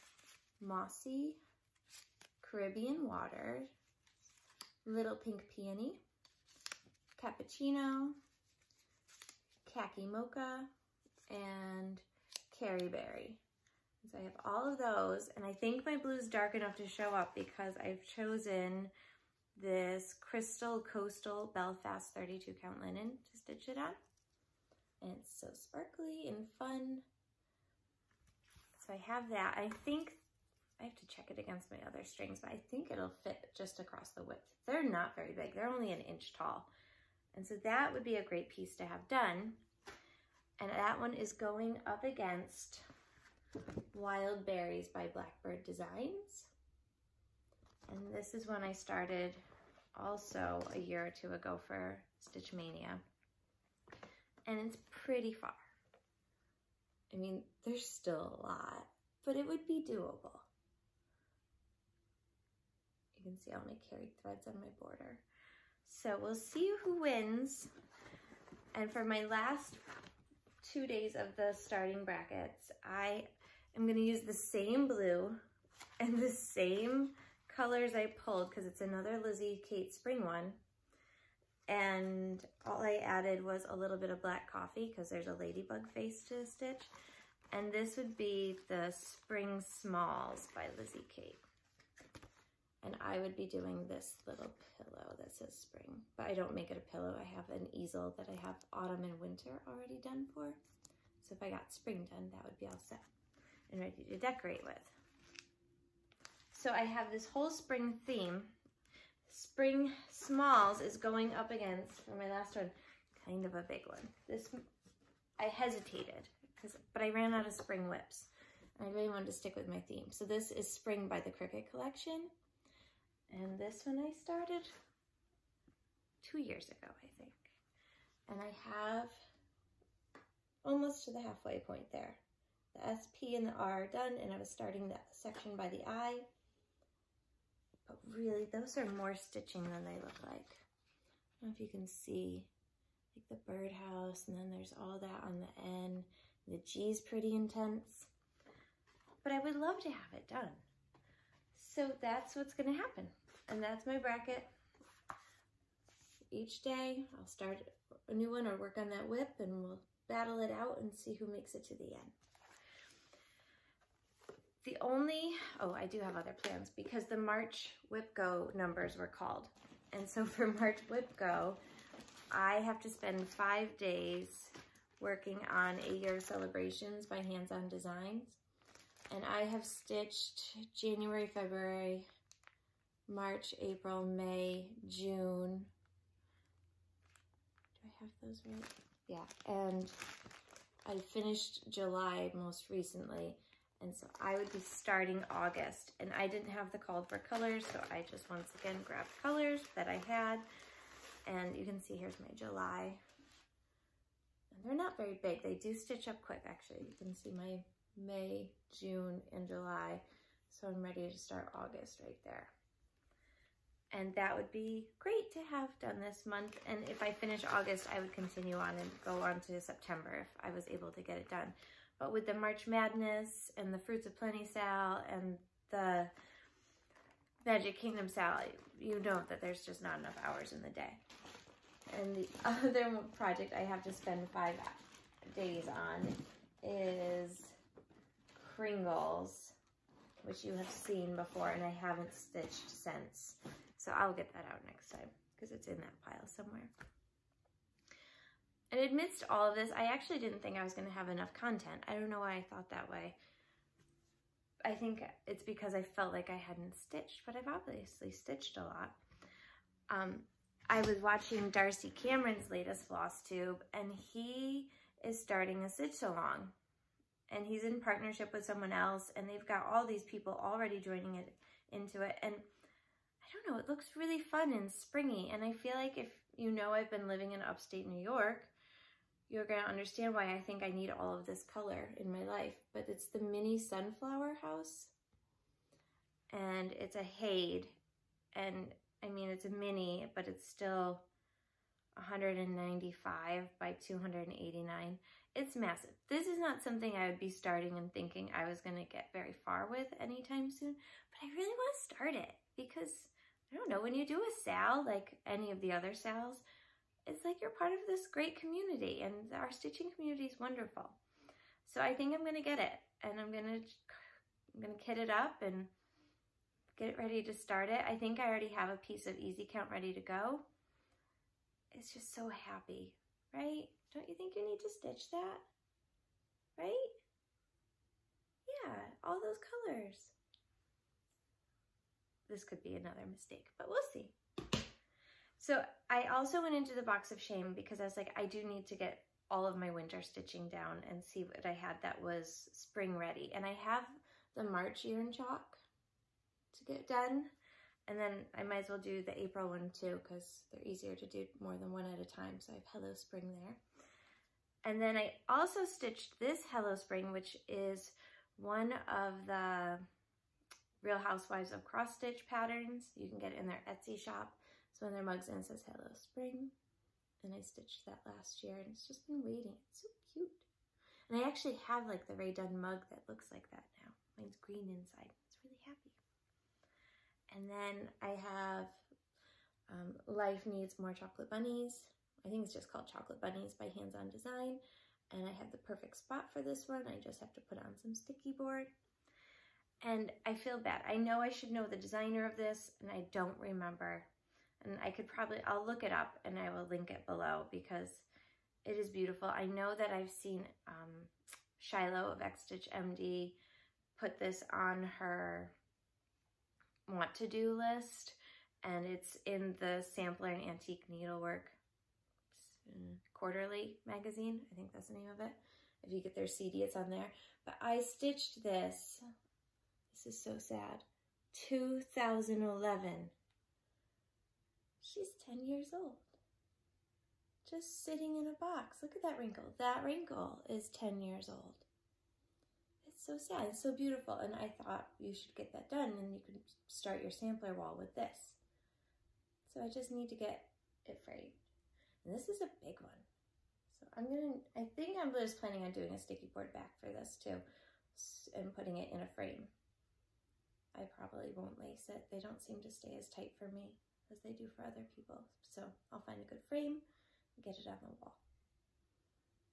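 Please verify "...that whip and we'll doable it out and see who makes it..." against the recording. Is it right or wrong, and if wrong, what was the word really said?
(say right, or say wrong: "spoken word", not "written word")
wrong: "battle", not "doable".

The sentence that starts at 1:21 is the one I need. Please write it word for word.
And all I added was a little bit of black coffee because there's a ladybug face to stitch.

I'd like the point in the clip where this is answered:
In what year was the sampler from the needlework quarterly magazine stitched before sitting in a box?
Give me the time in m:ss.
7:01.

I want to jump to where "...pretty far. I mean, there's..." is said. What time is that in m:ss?
0:54.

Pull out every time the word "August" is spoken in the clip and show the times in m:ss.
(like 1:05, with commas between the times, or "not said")
3:15, 3:31, 3:37.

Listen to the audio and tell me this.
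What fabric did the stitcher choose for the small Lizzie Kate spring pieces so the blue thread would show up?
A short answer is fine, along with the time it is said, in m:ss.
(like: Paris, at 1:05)
Belfast 32 count linen, at 0:21.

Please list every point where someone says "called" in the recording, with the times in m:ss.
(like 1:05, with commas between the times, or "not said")
2:49, 3:16, 6:22.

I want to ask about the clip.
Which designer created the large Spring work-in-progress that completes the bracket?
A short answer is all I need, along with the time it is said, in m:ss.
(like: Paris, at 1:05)
Cricket Collection, at 2:01.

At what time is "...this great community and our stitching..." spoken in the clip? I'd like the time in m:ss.
5:07.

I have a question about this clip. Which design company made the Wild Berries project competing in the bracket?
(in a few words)
Blackbird Designs.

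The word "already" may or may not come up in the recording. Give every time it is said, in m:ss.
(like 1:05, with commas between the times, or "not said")
1:39, 4:30, 5:18.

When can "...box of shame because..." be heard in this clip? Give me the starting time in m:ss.
5:36.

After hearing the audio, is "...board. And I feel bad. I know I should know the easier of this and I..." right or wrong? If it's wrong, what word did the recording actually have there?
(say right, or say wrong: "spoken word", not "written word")
wrong: "designer", not "easier".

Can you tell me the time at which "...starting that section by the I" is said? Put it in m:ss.
2:14.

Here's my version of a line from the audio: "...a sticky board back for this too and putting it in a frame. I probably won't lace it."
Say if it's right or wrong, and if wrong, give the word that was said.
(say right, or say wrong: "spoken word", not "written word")
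right.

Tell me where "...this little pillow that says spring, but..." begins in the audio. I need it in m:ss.
1:33.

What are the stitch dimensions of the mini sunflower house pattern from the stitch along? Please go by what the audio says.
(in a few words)
195 by 289.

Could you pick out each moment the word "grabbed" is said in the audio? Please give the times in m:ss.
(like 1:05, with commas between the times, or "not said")
3:18.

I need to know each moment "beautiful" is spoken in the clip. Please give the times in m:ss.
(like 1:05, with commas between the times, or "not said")
6:38, 7:13.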